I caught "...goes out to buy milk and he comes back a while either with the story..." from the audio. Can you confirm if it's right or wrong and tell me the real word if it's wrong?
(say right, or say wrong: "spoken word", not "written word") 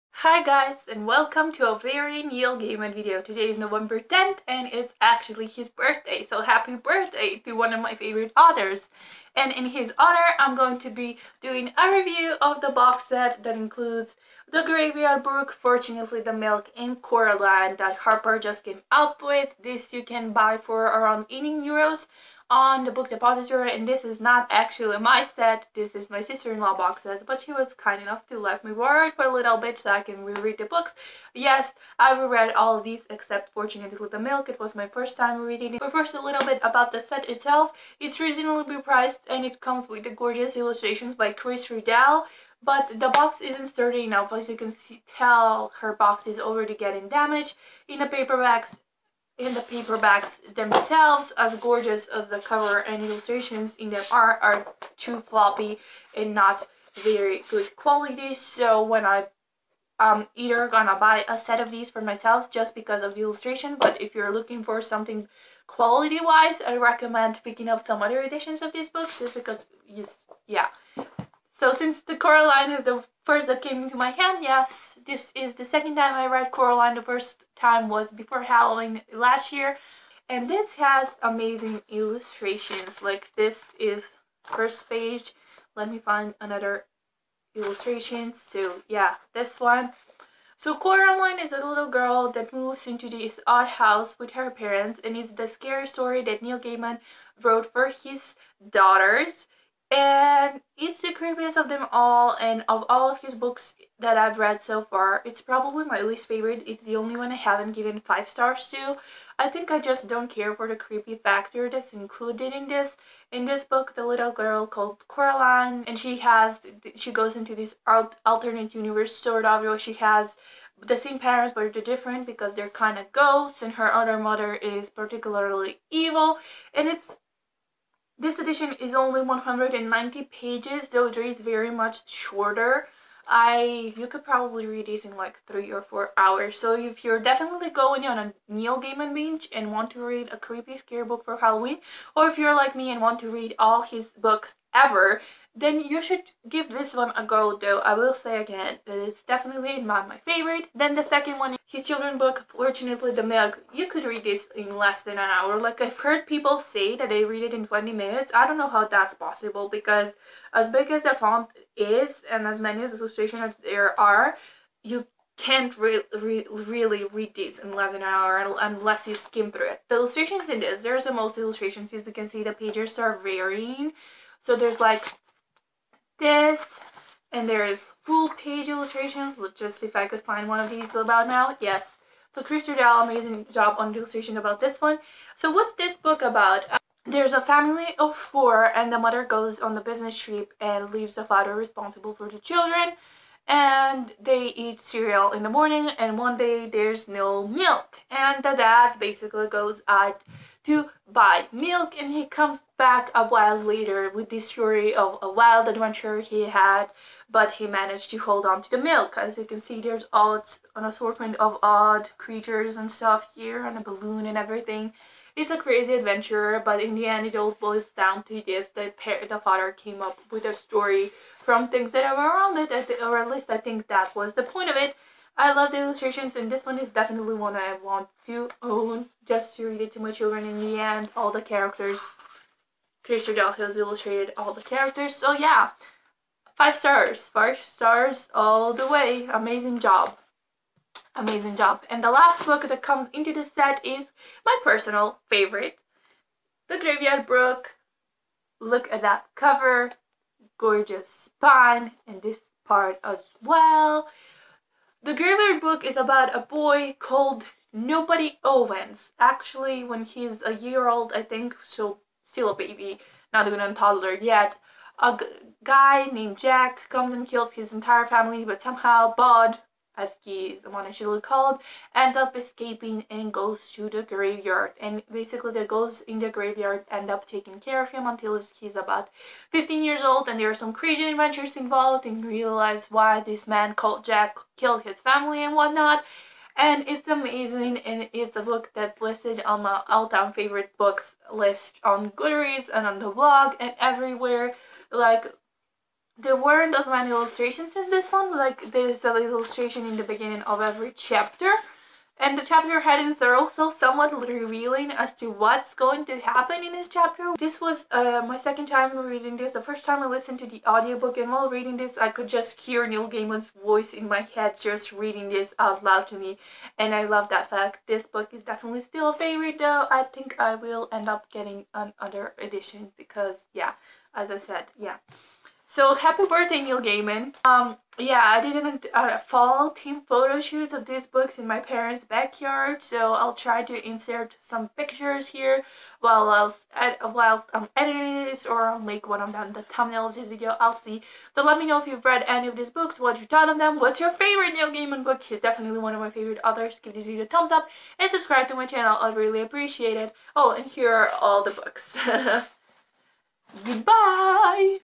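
wrong: "later", not "either".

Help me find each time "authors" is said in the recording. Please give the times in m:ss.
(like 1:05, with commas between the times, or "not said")
0:08, 5:46.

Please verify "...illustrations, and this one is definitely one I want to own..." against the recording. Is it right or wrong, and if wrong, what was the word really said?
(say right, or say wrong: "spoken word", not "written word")
right.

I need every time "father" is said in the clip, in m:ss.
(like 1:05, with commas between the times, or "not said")
3:11, 3:39.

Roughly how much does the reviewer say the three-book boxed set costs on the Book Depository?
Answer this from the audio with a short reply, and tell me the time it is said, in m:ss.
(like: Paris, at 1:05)
18 euros, at 0:21.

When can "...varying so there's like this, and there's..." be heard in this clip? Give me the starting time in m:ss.
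2:53.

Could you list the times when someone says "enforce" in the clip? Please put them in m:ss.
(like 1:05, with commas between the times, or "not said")
not said.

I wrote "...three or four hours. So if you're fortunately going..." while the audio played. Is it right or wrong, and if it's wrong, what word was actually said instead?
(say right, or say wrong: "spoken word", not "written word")
wrong: "definitely", not "fortunately".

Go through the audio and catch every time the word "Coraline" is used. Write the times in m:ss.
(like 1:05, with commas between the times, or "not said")
0:17, 1:12, 1:16, 1:30, 1:55.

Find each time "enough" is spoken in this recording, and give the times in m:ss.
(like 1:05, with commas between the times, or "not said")
0:28, 0:44.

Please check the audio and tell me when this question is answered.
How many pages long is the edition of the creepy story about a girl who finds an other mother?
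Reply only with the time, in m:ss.
2:09.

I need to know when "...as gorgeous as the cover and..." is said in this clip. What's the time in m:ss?
0:51.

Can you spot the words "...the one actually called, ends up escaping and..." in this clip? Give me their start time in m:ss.
4:30.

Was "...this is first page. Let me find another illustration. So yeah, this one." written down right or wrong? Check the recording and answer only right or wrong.
right.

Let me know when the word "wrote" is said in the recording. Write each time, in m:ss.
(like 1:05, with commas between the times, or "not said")
1:37.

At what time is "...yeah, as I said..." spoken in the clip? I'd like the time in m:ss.
5:23.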